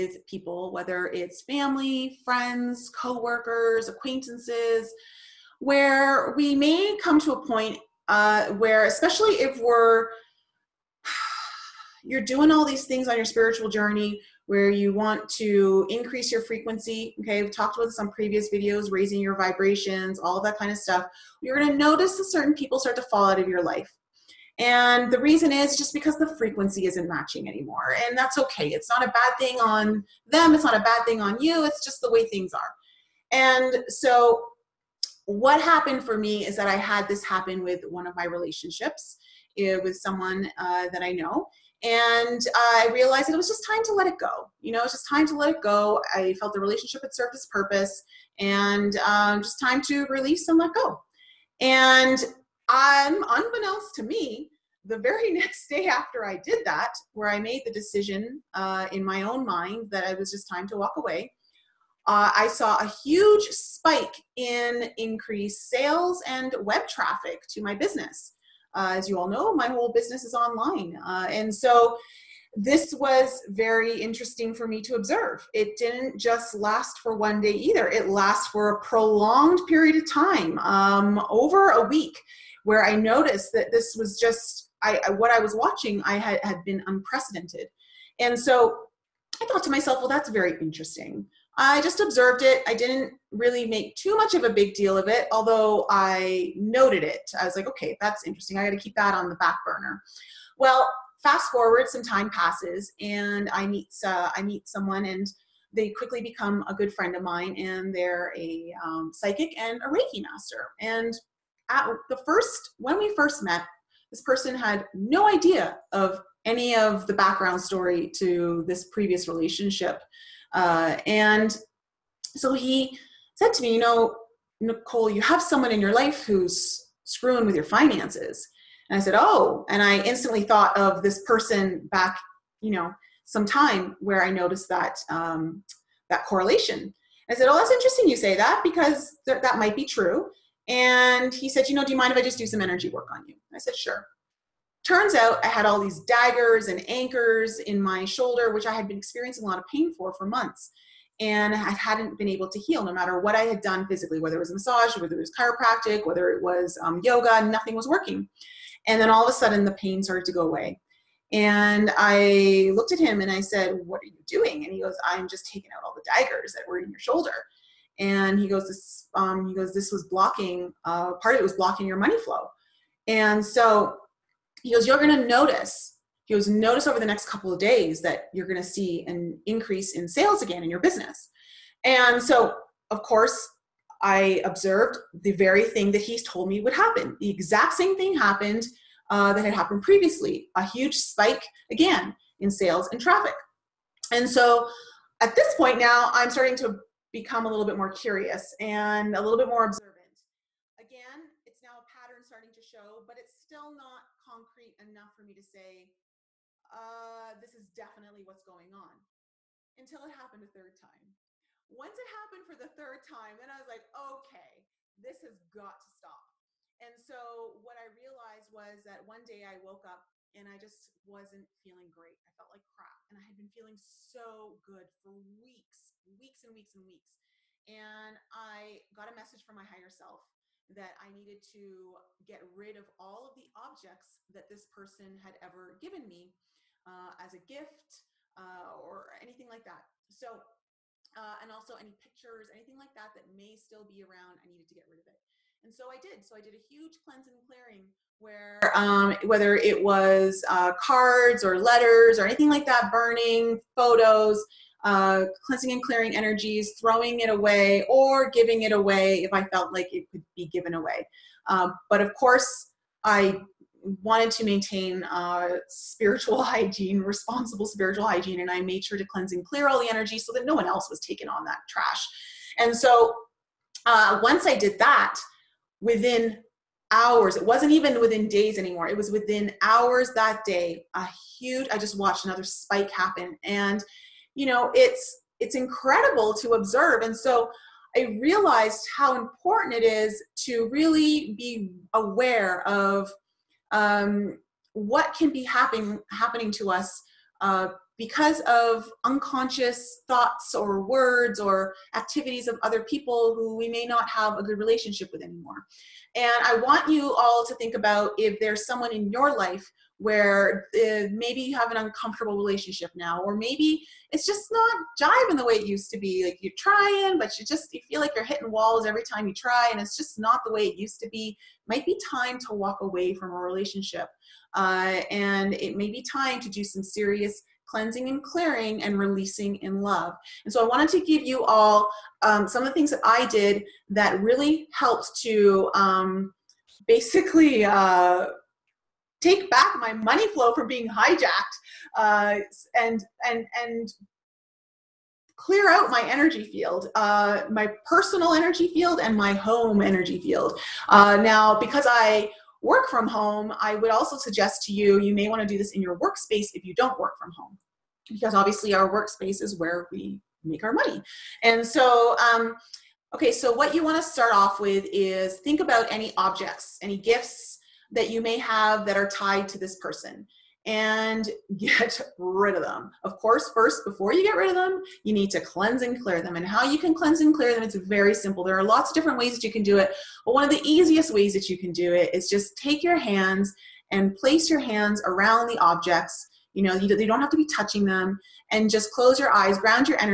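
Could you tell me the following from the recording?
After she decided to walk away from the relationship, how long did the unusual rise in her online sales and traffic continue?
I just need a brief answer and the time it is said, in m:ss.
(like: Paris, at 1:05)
over a week, at 1:21.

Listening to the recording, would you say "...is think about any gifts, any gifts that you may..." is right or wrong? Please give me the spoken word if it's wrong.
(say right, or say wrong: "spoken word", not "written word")
wrong: "objects", not "gifts".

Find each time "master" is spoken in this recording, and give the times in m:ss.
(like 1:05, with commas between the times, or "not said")
1:50.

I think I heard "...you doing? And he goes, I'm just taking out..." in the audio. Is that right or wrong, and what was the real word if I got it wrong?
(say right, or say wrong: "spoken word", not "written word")
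right.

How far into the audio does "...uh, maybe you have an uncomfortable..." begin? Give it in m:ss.
5:10.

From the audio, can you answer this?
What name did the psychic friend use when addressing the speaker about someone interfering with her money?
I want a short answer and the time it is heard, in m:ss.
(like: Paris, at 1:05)
Nicole, at 2:04.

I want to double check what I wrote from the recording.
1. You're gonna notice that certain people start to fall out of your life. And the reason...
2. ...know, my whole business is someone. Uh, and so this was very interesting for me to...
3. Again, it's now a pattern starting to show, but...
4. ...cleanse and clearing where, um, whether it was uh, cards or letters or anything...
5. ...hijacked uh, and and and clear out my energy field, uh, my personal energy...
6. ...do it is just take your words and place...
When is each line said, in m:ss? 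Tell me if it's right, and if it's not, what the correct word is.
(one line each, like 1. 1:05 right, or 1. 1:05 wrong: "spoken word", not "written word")
1. 0:21 right
2. 1:09 wrong: "online", not "someone"
3. 3:20 right
4. 4:07 right
5. 5:40 right
6. 6:21 wrong: "hands", not "words".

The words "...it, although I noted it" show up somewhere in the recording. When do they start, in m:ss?
1:35.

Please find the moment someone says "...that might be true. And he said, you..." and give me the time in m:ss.
2:19.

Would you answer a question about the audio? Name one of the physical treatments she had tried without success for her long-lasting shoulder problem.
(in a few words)
chiropractic.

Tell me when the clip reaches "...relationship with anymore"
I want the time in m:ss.
5:04.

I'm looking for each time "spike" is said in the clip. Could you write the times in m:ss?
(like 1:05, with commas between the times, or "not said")
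1:03, 3:10, 4:42.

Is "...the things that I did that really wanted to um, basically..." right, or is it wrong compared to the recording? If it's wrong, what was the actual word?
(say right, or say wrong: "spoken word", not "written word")
wrong: "helped", not "wanted".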